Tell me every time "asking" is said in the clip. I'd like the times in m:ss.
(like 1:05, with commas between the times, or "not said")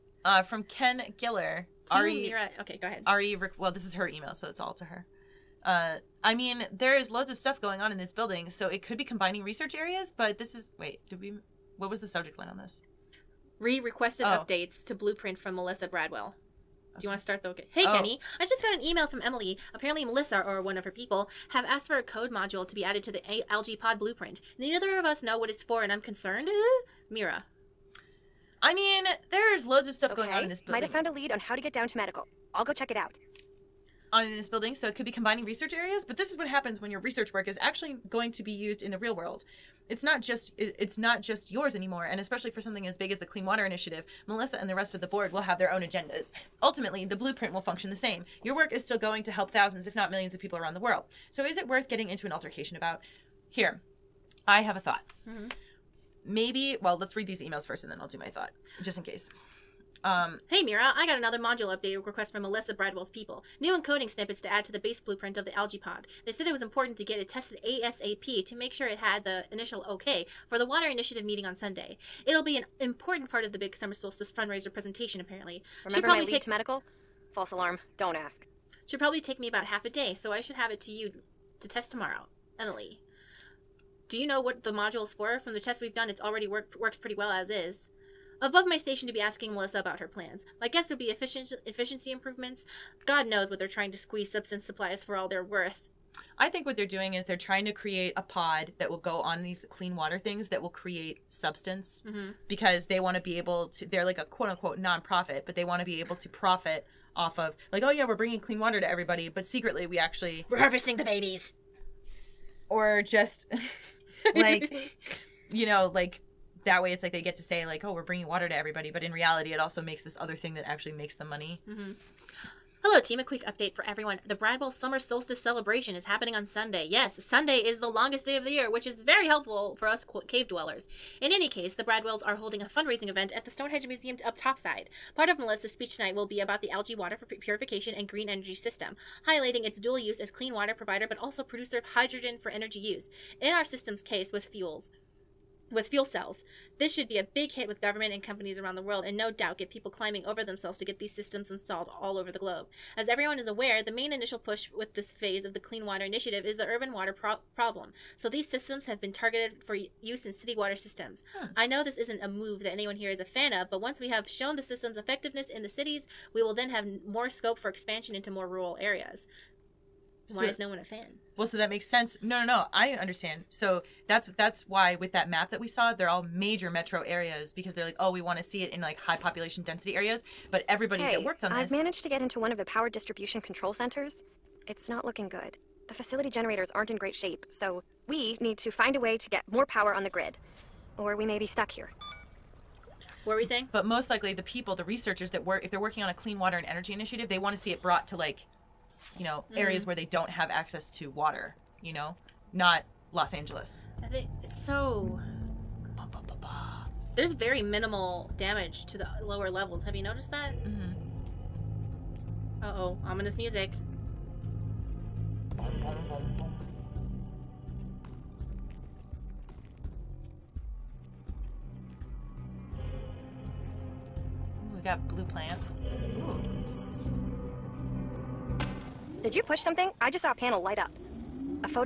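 1:29.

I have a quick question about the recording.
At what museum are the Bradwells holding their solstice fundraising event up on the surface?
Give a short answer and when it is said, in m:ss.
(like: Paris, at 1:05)
Stonehenge Museum, at 2:13.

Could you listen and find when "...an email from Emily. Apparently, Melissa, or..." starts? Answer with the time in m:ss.
0:18.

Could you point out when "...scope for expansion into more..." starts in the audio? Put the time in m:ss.
2:47.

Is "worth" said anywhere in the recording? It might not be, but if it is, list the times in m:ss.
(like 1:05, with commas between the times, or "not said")
0:51, 1:35.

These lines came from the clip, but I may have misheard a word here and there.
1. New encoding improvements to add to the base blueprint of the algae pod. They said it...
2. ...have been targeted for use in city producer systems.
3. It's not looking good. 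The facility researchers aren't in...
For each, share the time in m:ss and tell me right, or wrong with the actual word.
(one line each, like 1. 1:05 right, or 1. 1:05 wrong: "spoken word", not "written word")
1. 1:03 wrong: "snippets", not "improvements"
2. 2:38 wrong: "water", not "producer"
3. 3:04 wrong: "generators", not "researchers".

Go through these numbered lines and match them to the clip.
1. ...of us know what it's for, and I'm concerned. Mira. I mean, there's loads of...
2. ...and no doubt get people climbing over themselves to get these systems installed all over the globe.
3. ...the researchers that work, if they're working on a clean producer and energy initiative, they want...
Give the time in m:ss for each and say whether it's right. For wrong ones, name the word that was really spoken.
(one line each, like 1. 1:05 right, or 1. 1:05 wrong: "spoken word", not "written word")
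1. 0:24 right
2. 2:29 right
3. 3:14 wrong: "water", not "producer".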